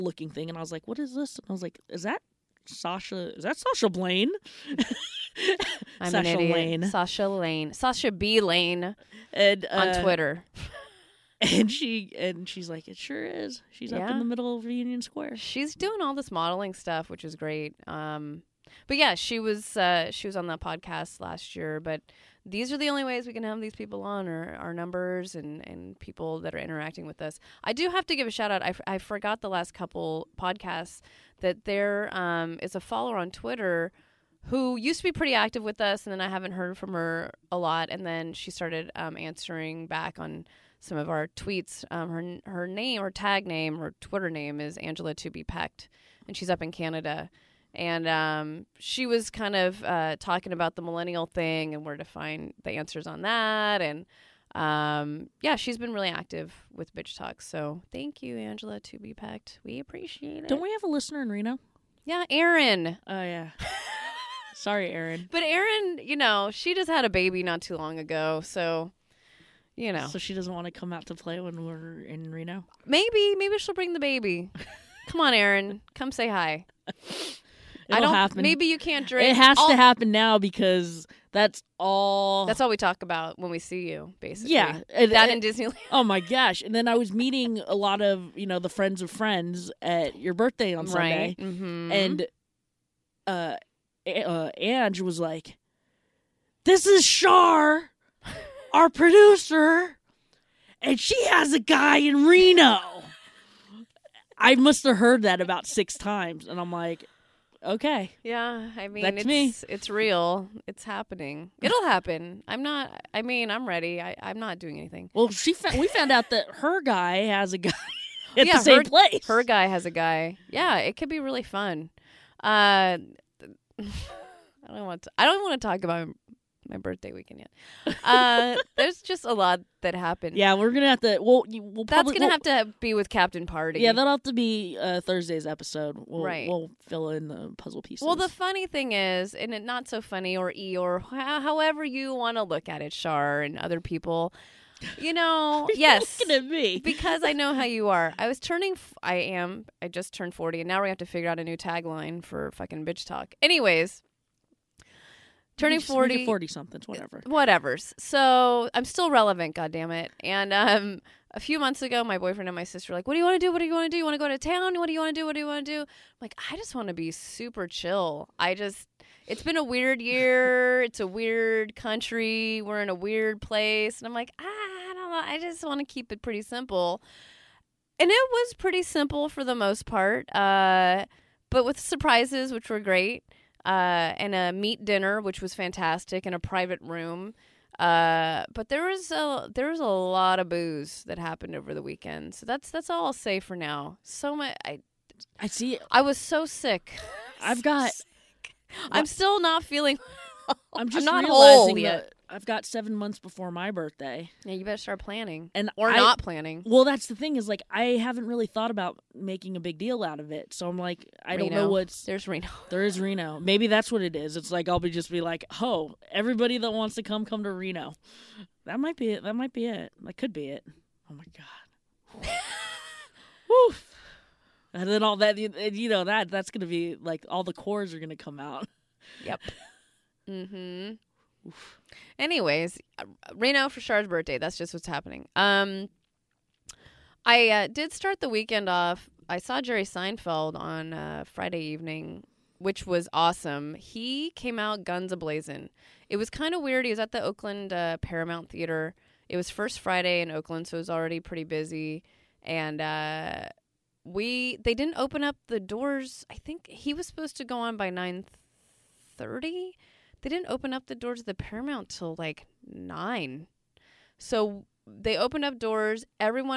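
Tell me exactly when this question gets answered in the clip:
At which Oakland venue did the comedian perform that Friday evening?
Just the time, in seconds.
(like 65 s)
247 s.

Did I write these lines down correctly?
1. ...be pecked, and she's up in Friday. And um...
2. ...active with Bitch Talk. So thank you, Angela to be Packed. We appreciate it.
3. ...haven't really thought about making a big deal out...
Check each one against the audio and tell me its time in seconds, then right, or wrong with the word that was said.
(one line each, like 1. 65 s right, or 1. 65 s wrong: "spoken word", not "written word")
1. 45 s wrong: "Canada", not "Friday"
2. 56 s right
3. 207 s right.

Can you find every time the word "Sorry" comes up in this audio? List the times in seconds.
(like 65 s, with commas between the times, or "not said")
64 s.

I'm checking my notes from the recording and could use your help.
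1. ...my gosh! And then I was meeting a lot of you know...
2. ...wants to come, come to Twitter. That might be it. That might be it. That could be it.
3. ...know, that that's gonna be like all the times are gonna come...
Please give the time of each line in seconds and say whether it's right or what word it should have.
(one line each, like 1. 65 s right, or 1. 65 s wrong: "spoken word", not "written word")
1. 86 s right
2. 216 s wrong: "Reno", not "Twitter"
3. 225 s wrong: "cores", not "times".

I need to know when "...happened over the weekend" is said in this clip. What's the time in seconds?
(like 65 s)
191 s.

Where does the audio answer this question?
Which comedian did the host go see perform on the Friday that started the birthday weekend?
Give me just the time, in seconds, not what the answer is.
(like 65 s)
239 s.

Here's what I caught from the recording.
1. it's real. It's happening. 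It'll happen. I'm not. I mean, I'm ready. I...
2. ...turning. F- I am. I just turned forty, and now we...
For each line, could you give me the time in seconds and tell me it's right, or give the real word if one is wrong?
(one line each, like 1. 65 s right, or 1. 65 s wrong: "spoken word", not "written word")
1. 109 s right
2. 148 s right.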